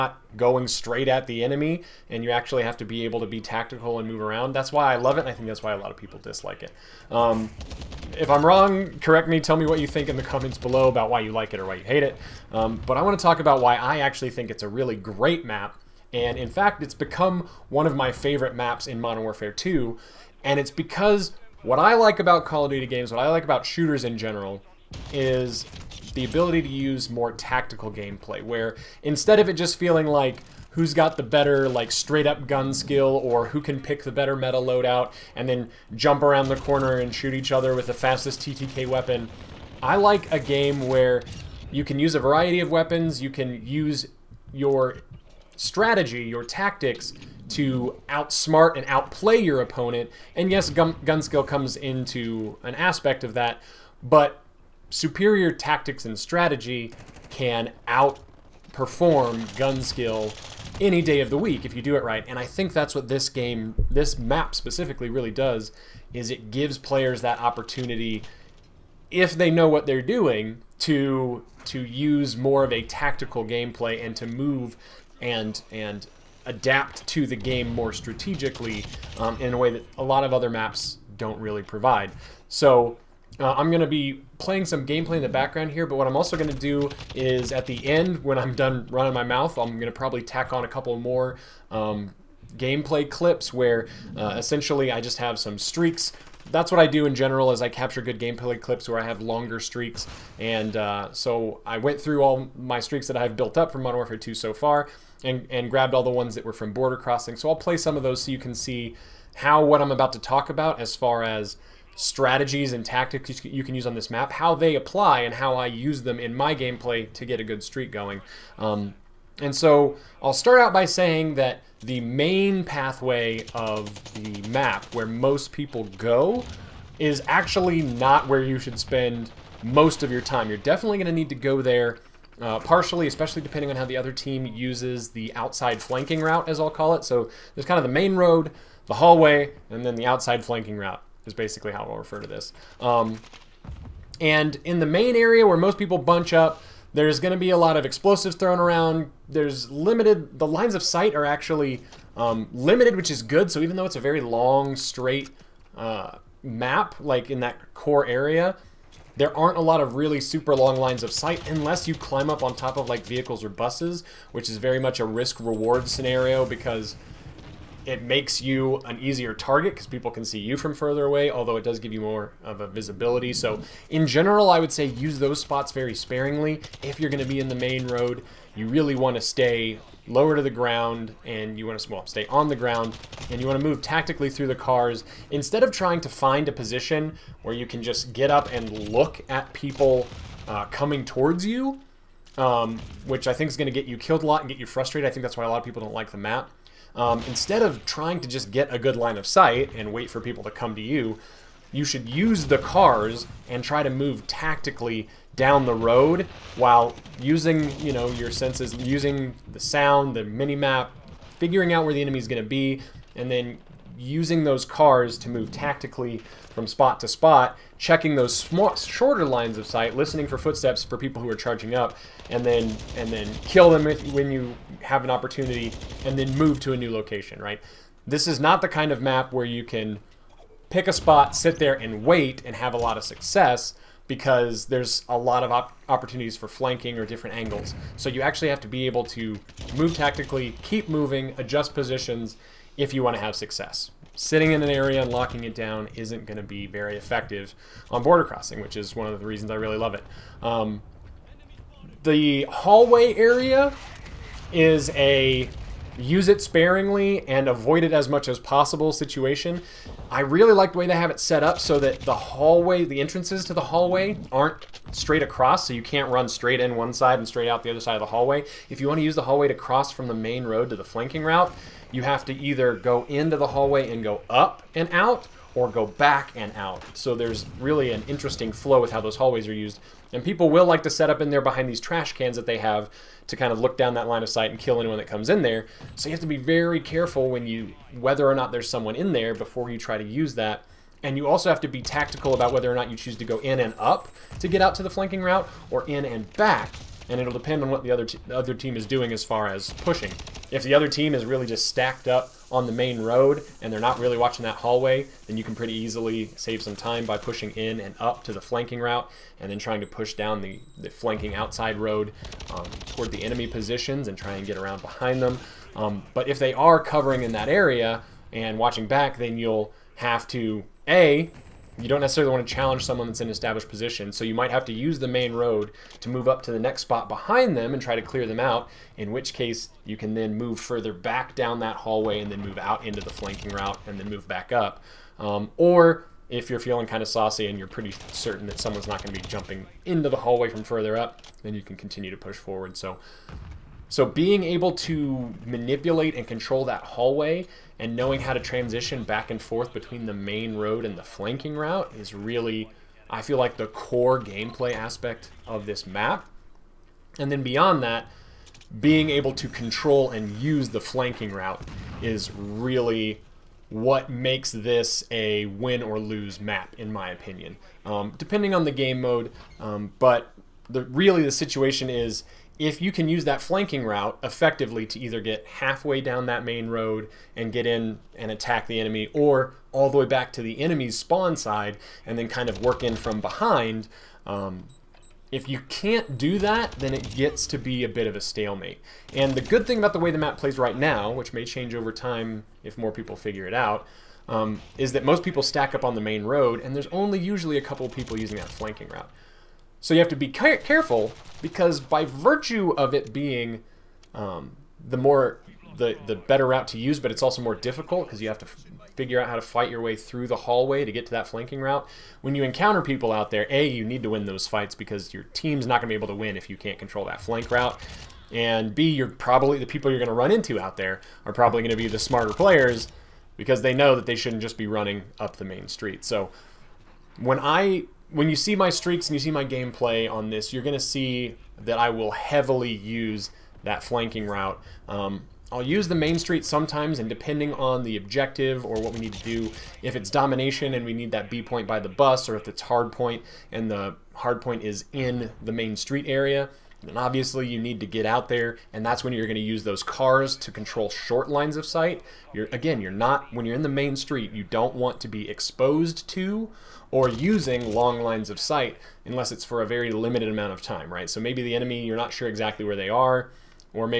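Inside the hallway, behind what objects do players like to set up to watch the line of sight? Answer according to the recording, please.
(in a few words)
trash cans.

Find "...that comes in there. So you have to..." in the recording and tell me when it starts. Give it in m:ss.
4:44.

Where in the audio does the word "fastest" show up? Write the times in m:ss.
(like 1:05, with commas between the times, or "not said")
0:37.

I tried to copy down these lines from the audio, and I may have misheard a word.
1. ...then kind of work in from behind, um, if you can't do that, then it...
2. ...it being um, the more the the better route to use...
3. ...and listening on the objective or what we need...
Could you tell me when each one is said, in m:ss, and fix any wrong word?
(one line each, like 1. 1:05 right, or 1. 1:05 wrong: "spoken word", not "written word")
1. 6:22 right
2. 6:42 right
3. 7:16 wrong: "depending", not "listening".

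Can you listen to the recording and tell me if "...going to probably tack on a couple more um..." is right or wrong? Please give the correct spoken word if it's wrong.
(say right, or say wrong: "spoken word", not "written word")
right.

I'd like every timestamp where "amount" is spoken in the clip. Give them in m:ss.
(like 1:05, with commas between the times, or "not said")
7:40.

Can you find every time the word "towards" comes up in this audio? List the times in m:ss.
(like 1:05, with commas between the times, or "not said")
3:11, 5:12.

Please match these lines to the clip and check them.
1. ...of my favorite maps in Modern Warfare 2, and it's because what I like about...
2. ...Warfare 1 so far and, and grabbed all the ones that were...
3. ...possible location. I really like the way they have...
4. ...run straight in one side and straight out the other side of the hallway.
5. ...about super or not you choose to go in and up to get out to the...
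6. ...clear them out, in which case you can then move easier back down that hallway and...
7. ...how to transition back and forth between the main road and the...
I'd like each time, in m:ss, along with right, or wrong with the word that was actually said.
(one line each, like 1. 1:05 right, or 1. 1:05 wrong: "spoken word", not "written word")
1. 0:17 right
2. 1:43 wrong: "2", not "1"
3. 4:18 wrong: "situation", not "location"
4. 4:26 right
5. 4:52 wrong: "whether", not "super"
6. 5:28 wrong: "further", not "easier"
7. 5:48 right.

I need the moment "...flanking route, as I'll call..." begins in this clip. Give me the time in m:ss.
2:15.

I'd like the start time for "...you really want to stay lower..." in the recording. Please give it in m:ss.
2:58.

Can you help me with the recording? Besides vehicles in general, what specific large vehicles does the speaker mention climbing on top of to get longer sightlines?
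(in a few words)
buses.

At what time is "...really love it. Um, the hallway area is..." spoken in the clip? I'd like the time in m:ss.
4:09.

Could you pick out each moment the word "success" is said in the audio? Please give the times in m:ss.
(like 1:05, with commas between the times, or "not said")
3:53, 4:03.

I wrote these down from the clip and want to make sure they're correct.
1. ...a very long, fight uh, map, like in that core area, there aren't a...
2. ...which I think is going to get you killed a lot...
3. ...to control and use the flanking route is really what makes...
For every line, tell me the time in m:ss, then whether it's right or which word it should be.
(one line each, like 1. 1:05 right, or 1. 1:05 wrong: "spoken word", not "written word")
1. 2:33 wrong: "straight", not "fight"
2. 3:13 right
3. 5:59 right.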